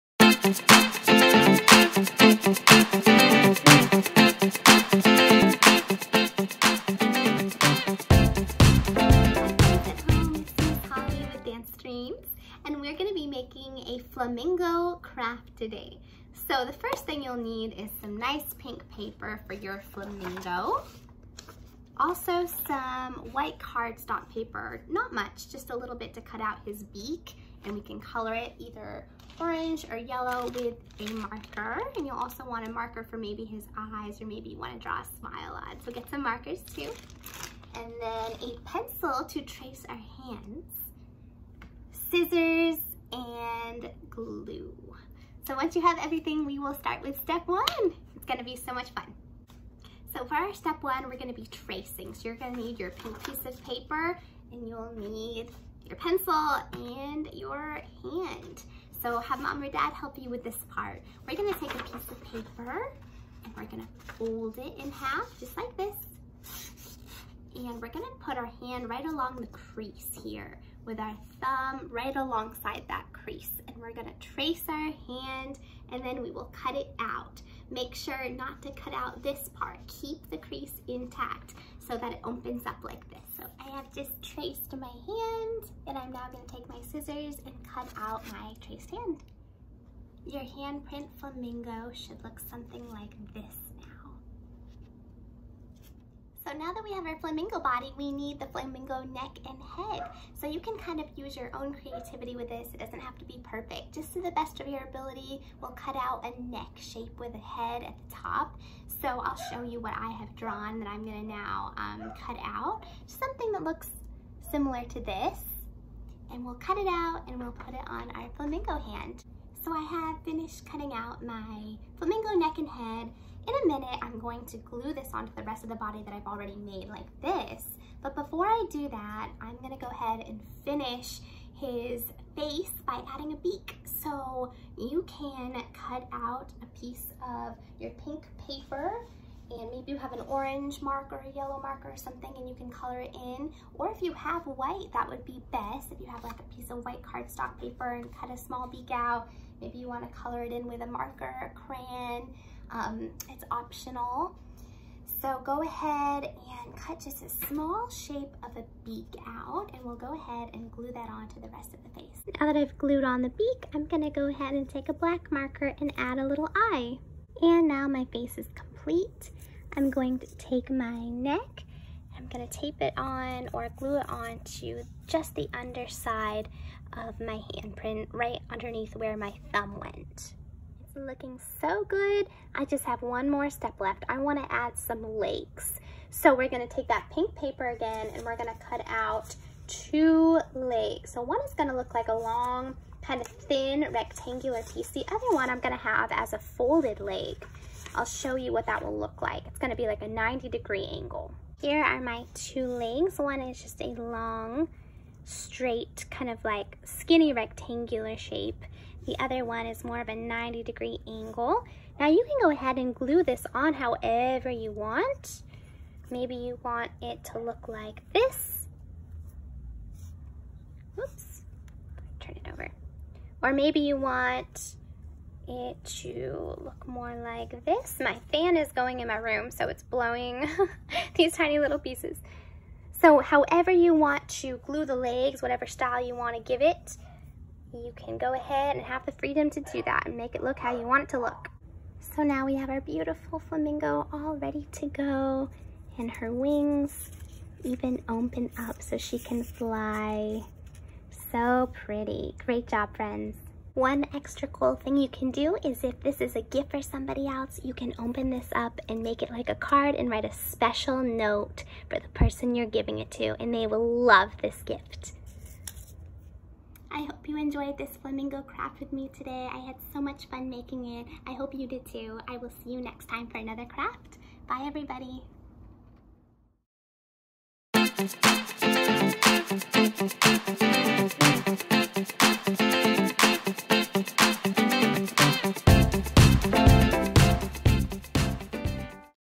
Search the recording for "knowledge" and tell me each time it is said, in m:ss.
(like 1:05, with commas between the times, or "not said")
not said.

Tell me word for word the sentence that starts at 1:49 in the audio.
So I'll show you what I have drawn that I'm gonna now um, cut out.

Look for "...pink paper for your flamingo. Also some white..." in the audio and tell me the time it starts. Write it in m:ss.
0:18.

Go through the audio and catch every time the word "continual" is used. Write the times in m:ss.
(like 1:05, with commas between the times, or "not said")
not said.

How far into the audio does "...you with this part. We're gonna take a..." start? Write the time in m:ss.
1:00.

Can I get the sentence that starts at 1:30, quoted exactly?
Your handprint flamingo should look something like this.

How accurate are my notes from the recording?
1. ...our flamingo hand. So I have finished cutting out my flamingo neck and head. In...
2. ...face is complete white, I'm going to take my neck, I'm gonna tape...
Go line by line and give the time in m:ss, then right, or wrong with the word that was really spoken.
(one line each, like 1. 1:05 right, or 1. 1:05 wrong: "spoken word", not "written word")
1. 1:58 right
2. 2:48 wrong: "complete", not "white".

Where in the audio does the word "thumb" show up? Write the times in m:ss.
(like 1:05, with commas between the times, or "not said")
1:11, 2:59.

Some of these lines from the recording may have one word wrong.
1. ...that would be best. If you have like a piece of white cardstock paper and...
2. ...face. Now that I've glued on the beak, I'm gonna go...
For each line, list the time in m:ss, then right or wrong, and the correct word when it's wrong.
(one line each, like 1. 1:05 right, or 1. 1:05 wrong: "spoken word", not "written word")
1. 2:24 right
2. 2:42 right.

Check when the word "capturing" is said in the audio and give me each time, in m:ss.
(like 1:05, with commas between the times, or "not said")
not said.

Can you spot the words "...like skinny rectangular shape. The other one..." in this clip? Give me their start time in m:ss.
3:26.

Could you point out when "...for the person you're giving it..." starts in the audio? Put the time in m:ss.
4:21.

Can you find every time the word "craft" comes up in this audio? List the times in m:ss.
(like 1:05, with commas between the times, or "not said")
0:15, 4:28, 4:33.